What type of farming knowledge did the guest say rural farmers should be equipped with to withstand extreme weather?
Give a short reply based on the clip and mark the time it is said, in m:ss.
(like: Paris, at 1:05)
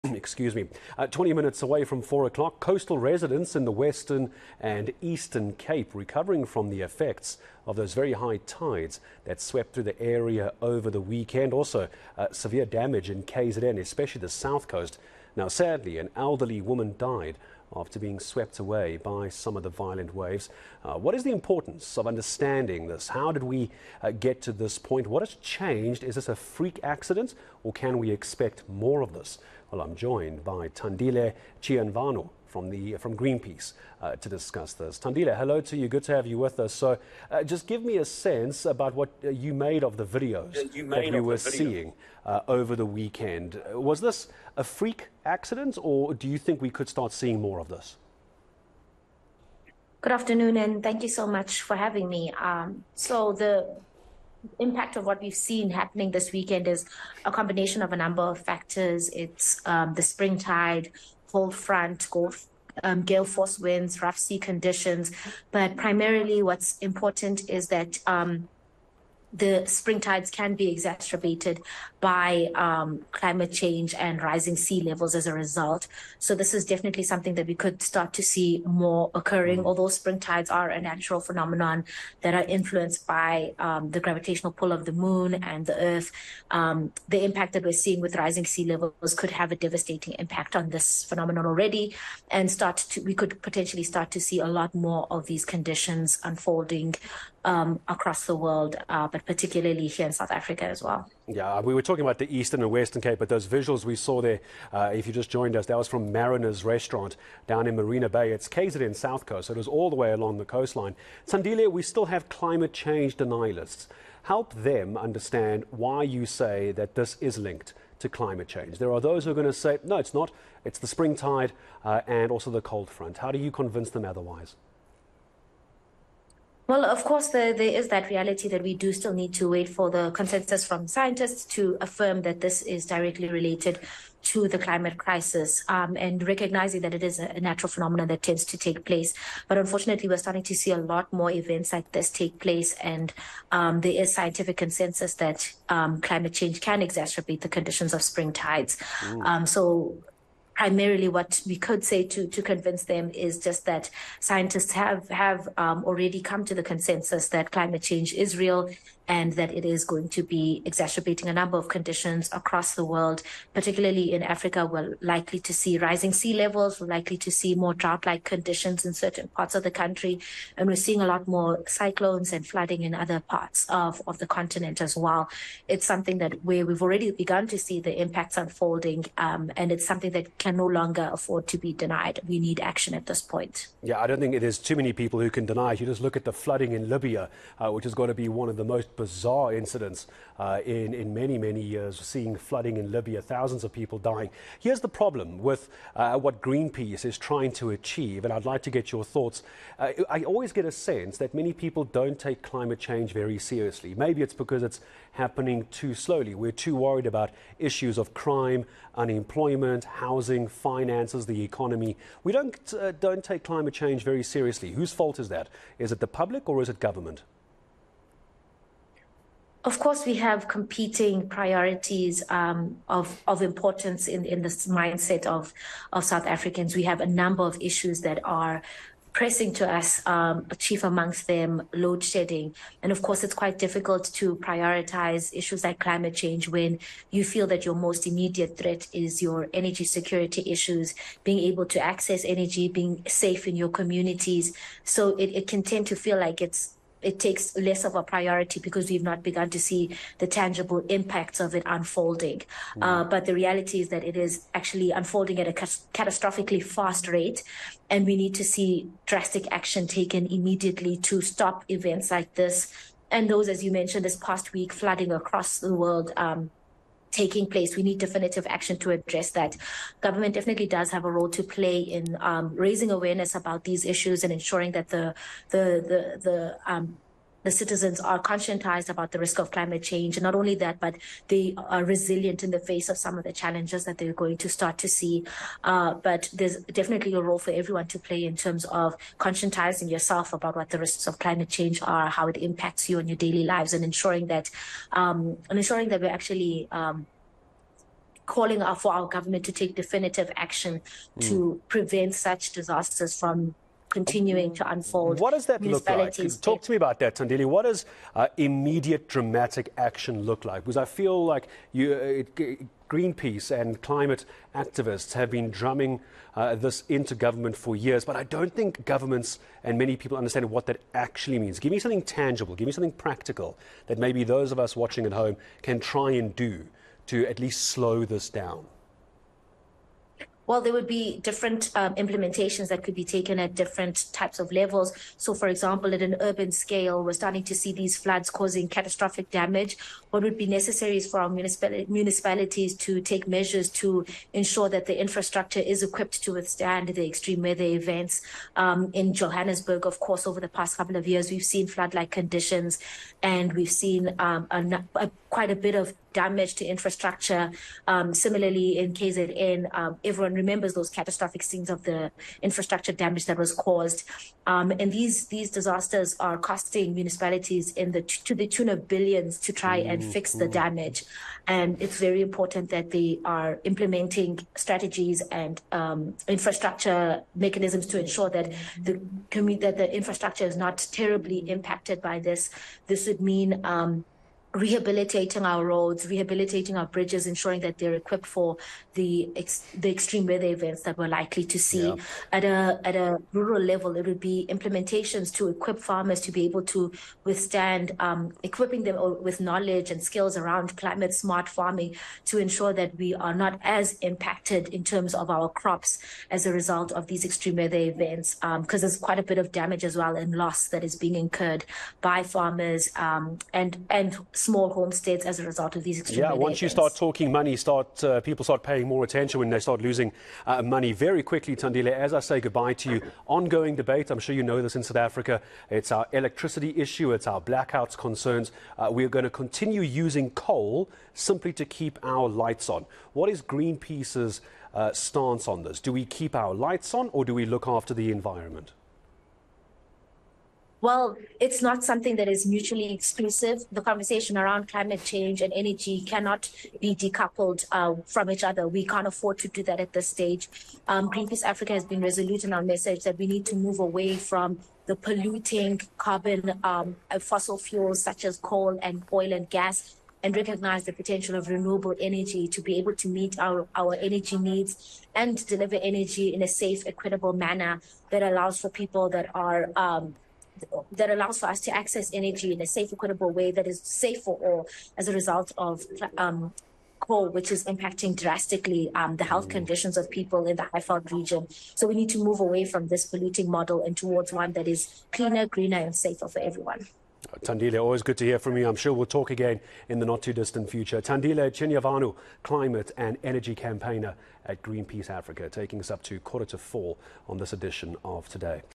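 Climate smart farming, at 6:40.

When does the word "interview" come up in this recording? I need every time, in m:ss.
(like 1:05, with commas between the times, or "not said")
not said.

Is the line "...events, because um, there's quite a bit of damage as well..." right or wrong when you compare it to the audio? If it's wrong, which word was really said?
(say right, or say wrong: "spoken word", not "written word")
right.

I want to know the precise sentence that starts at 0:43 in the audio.
Uh, was this a freak accident or do you think we could start seeing more of this?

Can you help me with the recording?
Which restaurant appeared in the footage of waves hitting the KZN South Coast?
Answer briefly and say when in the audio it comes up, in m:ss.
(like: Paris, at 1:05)
Mariner's Restaurant, at 1:46.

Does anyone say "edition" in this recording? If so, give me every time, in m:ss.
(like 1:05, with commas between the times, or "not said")
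8:17.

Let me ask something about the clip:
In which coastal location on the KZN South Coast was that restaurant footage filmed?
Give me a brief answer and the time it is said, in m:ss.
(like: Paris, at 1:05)
Marina Bay, at 1:47.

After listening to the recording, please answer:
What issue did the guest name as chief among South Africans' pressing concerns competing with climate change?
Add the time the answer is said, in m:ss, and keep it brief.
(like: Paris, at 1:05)
Load shedding, at 3:51.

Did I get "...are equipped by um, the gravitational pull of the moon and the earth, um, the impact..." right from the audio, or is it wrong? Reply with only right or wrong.
wrong.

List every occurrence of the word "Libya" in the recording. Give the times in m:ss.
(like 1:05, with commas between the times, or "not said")
3:06, 3:12.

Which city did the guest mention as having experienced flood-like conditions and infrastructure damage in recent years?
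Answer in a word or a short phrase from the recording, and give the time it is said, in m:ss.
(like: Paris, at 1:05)
Johannesburg, at 5:49.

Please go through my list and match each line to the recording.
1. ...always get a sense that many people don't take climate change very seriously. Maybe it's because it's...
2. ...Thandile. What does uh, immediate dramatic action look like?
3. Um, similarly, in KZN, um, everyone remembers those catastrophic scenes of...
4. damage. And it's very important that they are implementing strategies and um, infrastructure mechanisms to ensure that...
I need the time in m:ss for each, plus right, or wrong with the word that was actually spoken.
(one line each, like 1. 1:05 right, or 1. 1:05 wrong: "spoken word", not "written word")
1. 3:20 right
2. 5:07 right
3. 5:57 right
4. 6:10 right.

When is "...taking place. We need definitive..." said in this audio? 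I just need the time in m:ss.
4:27.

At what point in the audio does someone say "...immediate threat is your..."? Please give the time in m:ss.
3:58.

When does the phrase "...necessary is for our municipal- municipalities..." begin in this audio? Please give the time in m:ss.
5:40.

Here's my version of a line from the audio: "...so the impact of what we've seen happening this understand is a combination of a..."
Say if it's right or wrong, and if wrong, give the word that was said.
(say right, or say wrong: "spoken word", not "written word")
wrong: "weekend", not "understand".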